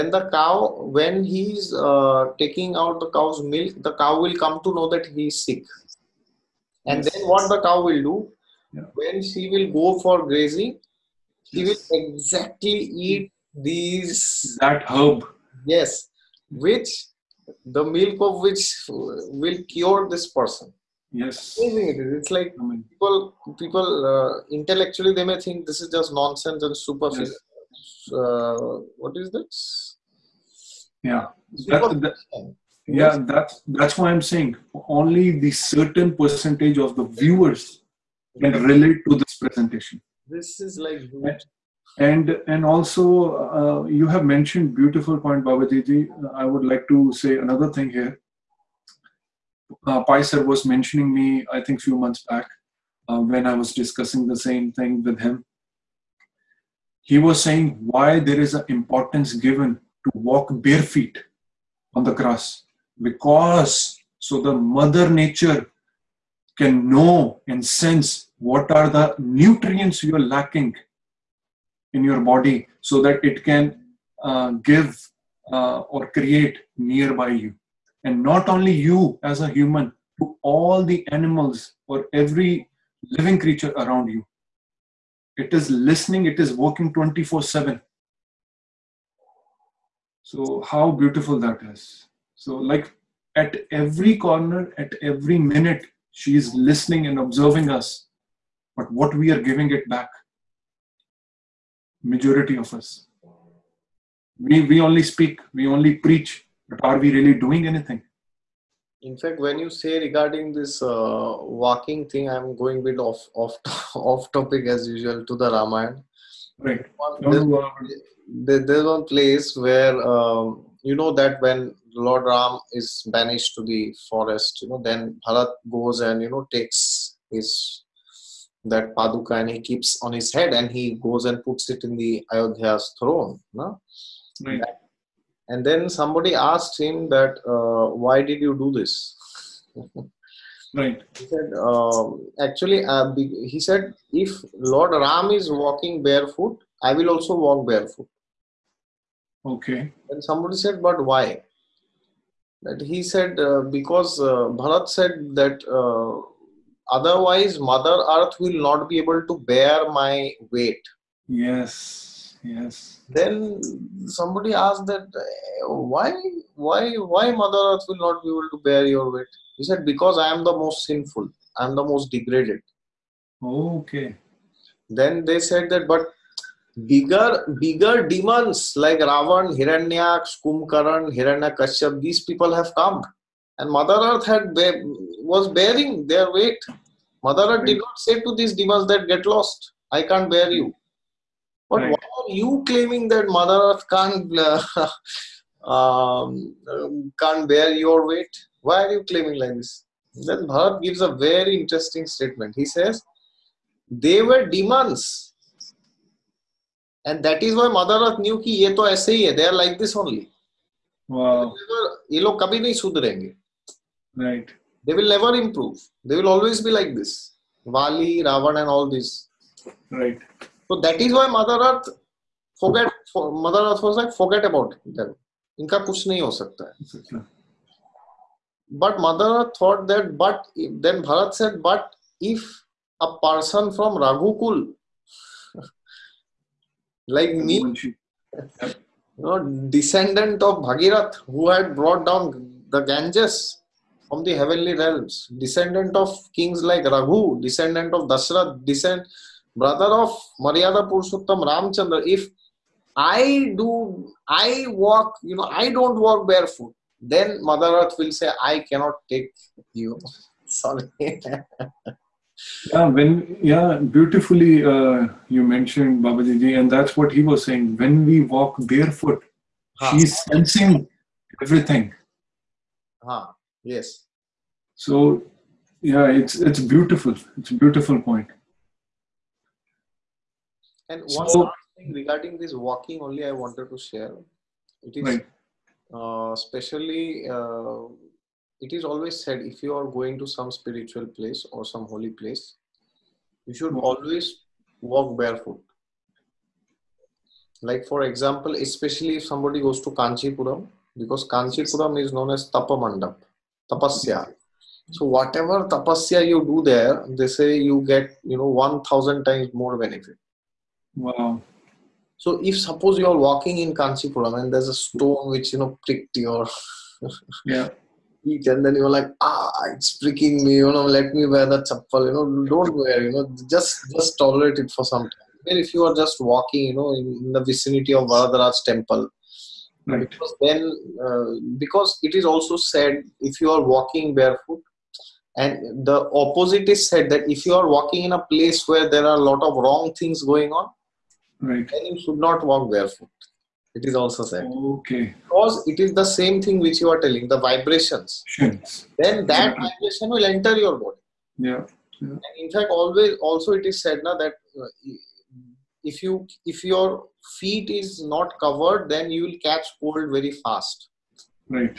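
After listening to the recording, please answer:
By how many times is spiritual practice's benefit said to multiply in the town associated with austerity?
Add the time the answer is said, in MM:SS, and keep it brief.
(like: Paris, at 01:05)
1000, at 05:08.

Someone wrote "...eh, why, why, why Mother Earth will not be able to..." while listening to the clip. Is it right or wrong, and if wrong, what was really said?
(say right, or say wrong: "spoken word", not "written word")
right.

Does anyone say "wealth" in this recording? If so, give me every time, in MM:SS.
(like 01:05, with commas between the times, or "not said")
not said.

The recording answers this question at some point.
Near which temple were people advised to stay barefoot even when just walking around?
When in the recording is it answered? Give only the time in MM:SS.
05:28.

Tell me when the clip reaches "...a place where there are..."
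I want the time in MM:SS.
05:38.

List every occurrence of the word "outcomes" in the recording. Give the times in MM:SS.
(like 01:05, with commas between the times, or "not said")
not said.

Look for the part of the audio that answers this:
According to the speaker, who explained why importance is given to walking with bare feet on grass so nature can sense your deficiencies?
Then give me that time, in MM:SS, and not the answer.
00:50.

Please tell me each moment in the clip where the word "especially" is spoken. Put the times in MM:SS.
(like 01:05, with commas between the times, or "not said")
04:46, 04:58.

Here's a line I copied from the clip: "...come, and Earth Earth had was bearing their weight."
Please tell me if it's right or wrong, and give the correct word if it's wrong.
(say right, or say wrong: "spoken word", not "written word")
wrong: "Mother", not "Earth".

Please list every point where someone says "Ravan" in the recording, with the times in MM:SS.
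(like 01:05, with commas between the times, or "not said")
02:58, 03:38.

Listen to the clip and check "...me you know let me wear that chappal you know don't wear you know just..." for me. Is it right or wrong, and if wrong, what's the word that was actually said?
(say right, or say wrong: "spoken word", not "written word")
right.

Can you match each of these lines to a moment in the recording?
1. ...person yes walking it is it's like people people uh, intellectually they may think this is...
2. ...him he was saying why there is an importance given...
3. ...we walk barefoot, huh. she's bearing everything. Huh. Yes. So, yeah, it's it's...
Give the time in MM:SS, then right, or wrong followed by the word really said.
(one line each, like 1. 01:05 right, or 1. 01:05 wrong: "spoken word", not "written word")
1. 00:20 wrong: "amazing", not "walking"
2. 00:55 right
3. 04:28 wrong: "sensing", not "bearing".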